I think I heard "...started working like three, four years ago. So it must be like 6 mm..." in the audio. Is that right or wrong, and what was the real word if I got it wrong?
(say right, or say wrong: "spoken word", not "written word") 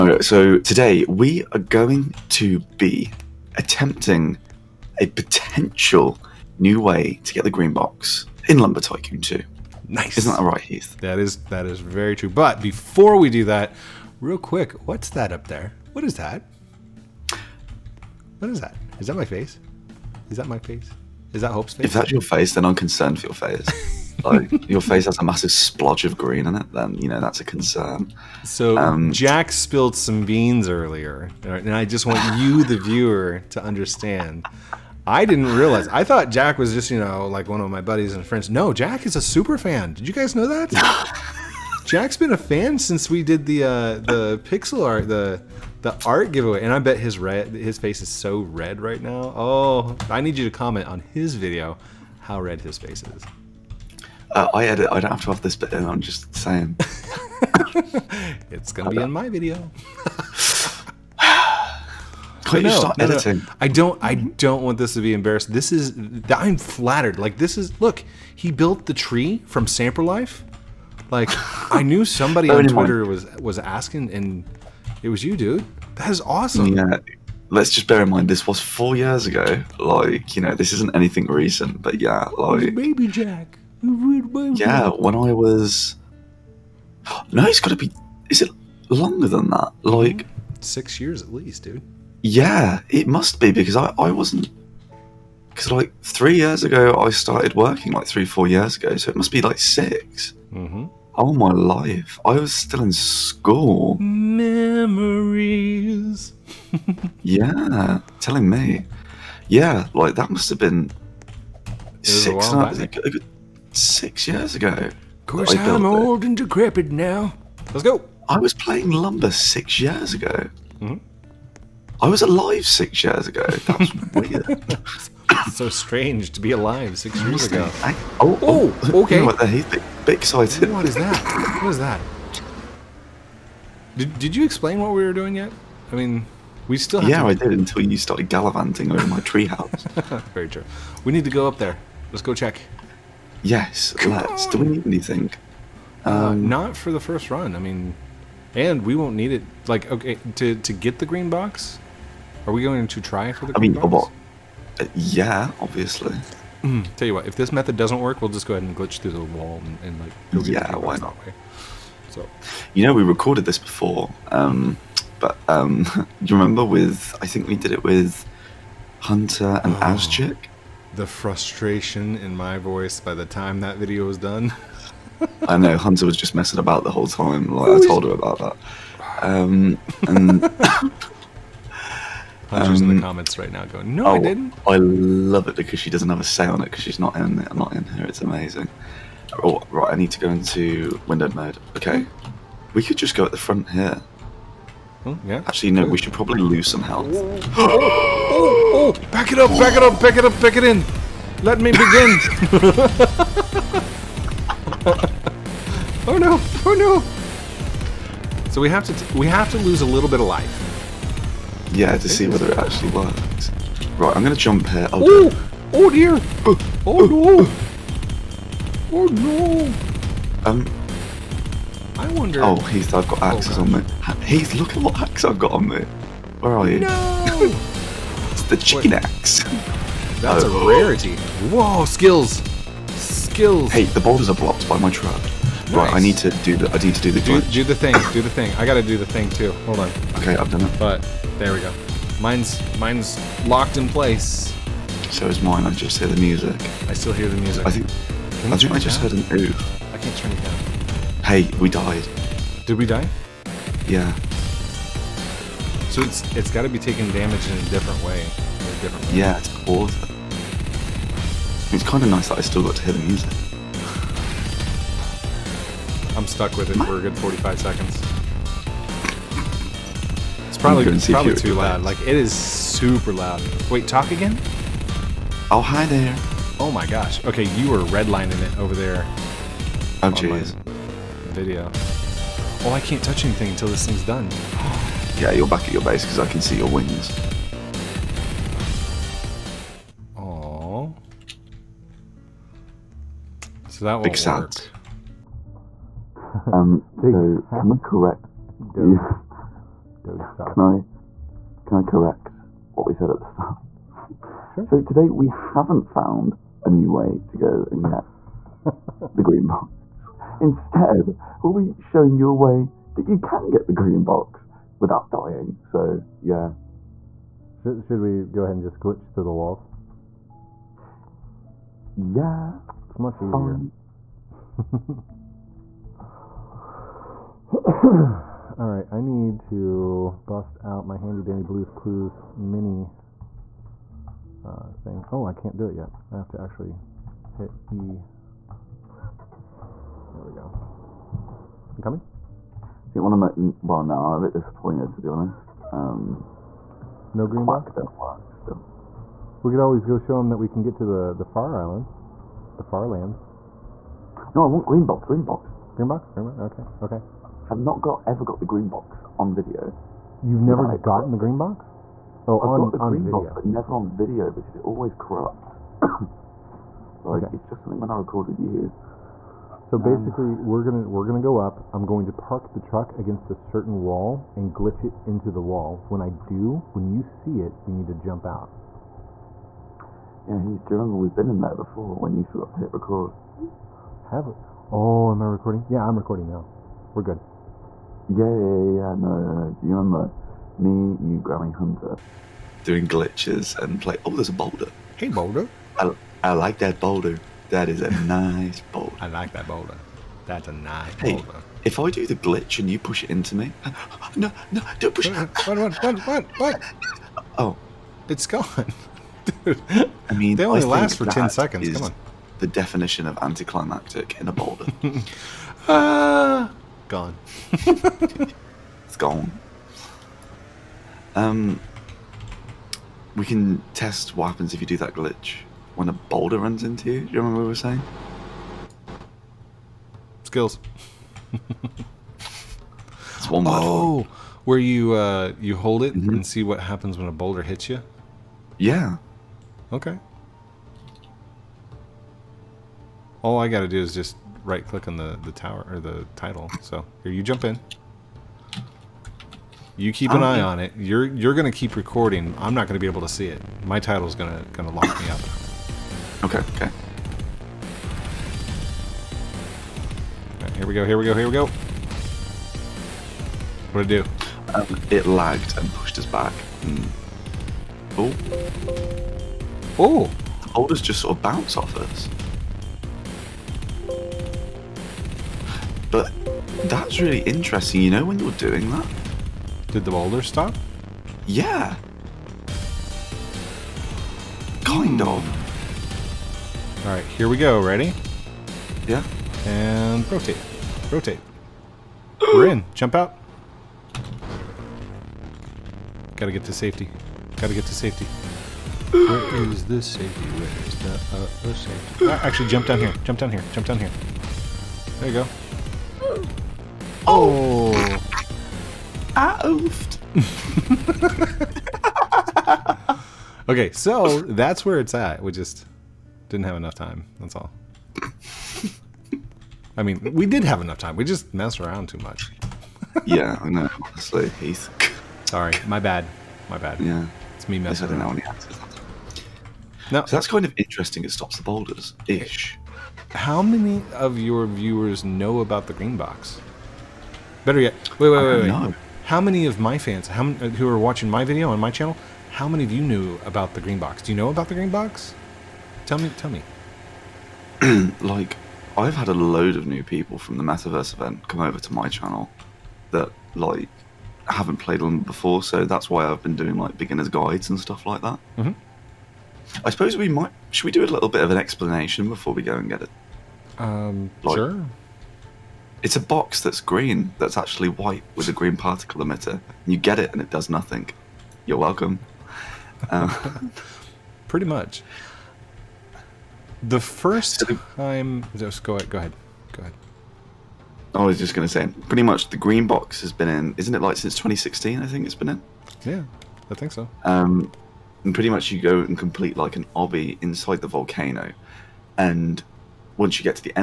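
right.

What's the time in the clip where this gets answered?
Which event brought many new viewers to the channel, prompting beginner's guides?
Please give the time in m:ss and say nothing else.
9:10.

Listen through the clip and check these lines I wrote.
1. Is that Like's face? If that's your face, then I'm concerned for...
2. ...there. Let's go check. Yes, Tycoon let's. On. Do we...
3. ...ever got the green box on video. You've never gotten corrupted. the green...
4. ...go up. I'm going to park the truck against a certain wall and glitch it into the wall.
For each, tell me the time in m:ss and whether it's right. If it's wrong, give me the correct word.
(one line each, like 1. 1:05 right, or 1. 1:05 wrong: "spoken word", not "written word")
1. 0:21 wrong: "Hope", not "Like"
2. 2:21 wrong: "Come", not "Tycoon"
3. 5:58 right
4. 6:11 right.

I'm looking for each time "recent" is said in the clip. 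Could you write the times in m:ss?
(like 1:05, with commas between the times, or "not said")
1:21.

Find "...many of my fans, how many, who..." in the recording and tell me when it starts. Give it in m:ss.
8:59.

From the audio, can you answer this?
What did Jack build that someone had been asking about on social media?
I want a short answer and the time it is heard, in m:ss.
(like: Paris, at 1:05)
The tree from Samper Life, at 1:08.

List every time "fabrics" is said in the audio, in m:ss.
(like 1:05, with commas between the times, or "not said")
not said.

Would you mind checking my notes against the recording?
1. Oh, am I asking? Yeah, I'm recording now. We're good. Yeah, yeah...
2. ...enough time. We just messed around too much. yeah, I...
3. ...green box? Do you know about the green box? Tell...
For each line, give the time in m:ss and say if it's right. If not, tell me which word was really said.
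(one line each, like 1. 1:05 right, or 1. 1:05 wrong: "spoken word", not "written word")
1. 6:24 wrong: "recording", not "asking"
2. 8:40 right
3. 9:03 right.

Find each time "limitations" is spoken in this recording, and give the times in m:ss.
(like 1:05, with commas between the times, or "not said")
not said.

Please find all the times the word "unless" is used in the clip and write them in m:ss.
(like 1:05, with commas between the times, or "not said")
not said.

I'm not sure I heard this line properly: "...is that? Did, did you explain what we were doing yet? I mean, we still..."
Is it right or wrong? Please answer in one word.
right.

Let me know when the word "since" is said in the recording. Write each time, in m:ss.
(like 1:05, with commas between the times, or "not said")
0:42, 9:43.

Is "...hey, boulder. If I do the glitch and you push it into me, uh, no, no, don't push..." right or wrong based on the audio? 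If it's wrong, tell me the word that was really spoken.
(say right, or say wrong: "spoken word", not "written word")
right.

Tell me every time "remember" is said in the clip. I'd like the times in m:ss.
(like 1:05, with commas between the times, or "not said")
2:46, 6:20, 6:29, 7:07.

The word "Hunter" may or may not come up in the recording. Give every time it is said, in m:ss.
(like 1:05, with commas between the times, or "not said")
2:49, 2:55, 3:02, 6:31.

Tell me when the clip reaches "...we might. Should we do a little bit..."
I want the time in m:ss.
9:19.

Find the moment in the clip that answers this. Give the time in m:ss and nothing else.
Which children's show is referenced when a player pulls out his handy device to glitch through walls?
5:31.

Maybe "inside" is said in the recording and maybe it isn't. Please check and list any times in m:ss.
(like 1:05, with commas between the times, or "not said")
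9:50.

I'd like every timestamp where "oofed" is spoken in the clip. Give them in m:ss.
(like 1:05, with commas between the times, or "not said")
8:29.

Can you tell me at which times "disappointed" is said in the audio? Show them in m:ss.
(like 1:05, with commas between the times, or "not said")
5:44.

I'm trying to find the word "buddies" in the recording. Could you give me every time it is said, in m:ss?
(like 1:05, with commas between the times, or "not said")
0:37.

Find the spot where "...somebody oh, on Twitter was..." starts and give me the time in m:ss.
1:12.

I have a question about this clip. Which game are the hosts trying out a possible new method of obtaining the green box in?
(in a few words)
Lumber Tycoon 2.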